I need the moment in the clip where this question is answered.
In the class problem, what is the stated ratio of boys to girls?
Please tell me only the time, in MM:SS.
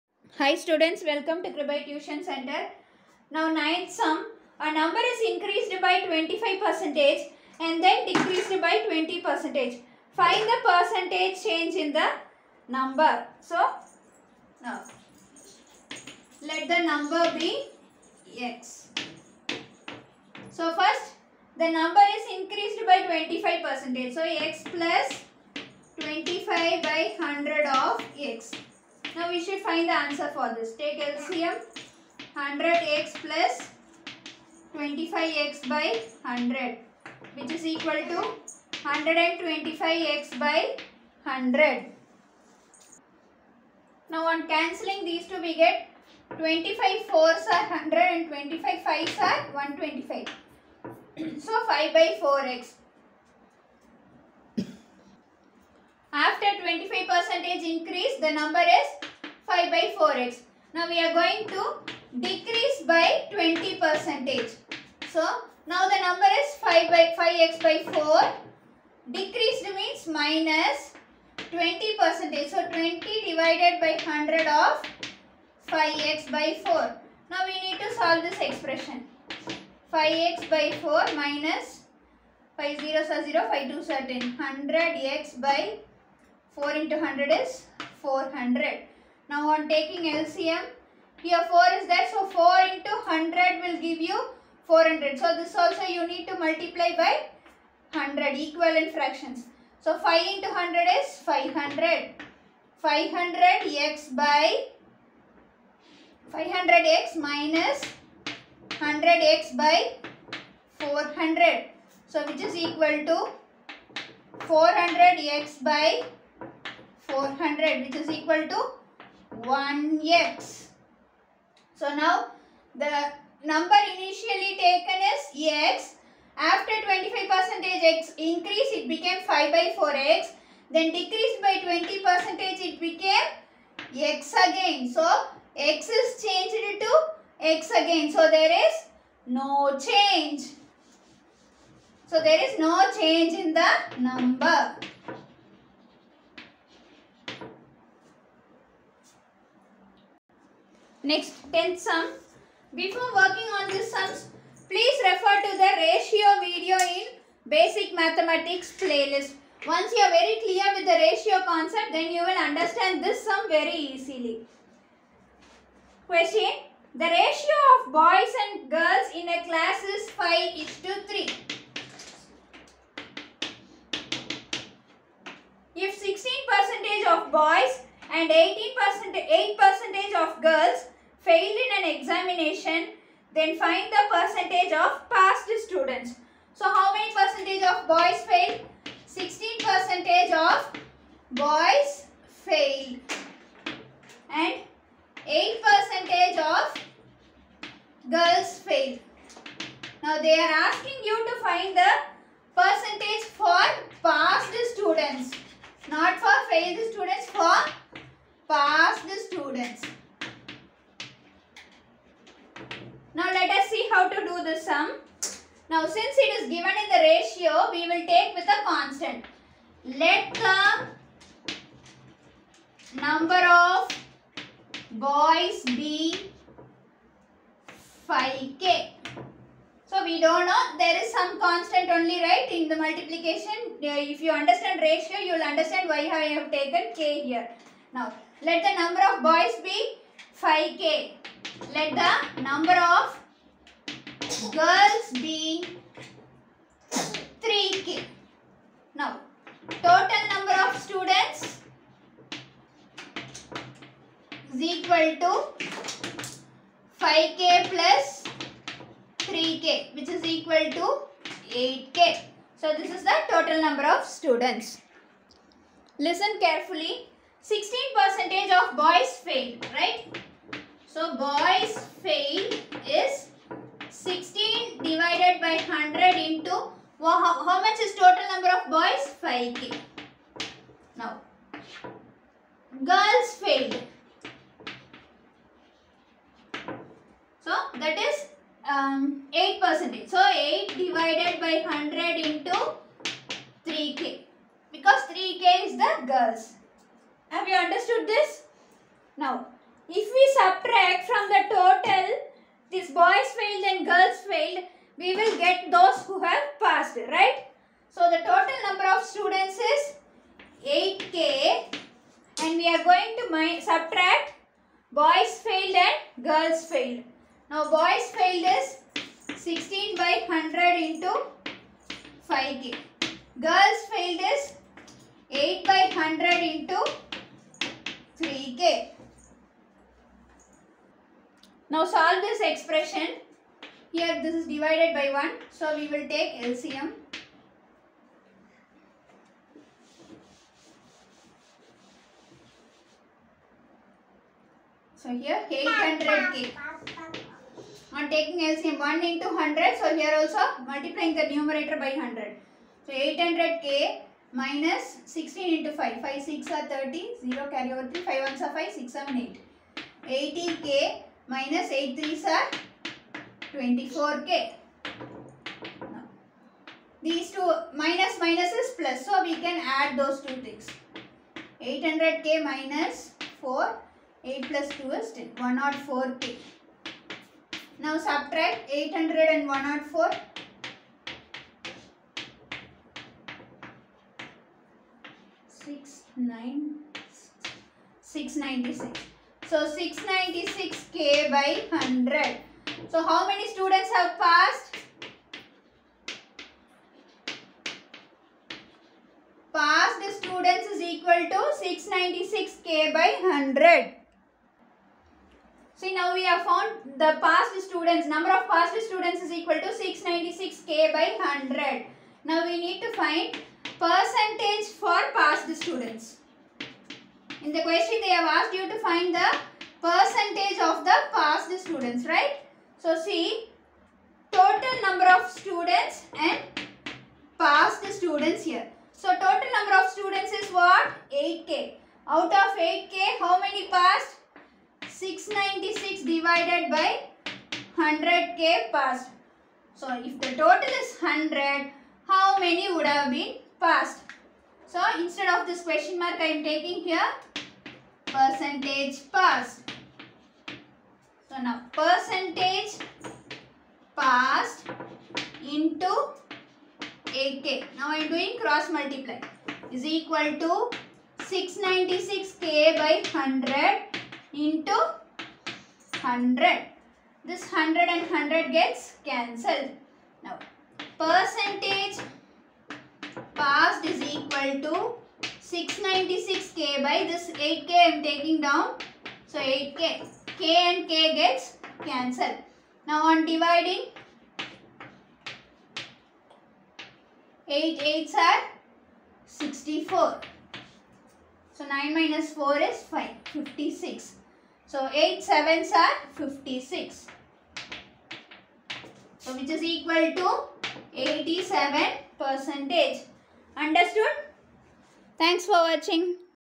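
02:50.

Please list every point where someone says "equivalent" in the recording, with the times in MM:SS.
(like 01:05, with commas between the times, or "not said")
01:38.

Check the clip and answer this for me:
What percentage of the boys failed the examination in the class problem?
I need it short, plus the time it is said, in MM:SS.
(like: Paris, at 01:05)
16%, at 03:09.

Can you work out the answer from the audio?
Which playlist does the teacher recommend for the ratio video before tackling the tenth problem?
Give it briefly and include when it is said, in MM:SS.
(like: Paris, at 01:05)
basic mathematics, at 02:37.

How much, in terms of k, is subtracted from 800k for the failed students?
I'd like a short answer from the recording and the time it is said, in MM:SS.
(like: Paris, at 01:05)
104k, at 06:15.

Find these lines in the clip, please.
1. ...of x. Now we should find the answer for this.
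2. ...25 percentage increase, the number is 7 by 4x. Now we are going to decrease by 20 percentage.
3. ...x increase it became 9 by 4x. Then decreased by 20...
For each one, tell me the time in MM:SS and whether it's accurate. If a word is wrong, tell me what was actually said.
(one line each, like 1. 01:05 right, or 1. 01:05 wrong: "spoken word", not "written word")
1. 00:27 right
2. 00:56 wrong: "5", not "7"
3. 02:07 wrong: "5", not "9".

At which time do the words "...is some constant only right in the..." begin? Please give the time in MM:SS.
03:51.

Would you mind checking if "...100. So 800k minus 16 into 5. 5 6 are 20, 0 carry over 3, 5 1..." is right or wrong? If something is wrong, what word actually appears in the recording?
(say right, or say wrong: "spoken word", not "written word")
wrong: "30", not "20".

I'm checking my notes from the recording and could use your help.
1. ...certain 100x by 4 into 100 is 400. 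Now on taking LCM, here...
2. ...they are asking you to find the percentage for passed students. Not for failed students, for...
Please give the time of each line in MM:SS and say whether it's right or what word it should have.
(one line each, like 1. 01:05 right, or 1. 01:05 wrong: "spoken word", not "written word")
1. 01:23 right
2. 03:20 right.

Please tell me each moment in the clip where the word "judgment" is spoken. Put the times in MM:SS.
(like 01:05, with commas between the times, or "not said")
not said.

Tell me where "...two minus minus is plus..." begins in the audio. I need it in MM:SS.
06:07.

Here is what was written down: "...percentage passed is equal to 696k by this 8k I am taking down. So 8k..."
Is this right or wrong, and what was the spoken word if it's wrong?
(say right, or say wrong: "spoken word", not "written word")
right.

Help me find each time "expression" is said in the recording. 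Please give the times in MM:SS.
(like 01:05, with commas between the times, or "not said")
01:18, 05:32.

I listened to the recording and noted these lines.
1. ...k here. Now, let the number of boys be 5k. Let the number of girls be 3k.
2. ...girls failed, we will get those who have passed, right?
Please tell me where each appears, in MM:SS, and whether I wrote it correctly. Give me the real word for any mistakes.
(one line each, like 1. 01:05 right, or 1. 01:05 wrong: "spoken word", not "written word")
1. 03:57 right
2. 05:03 right.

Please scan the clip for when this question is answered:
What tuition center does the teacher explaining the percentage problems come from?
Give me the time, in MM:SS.
00:01.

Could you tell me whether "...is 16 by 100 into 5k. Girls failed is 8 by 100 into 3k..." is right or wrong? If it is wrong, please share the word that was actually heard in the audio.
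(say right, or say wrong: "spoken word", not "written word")
right.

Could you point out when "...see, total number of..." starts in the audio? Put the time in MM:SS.
07:03.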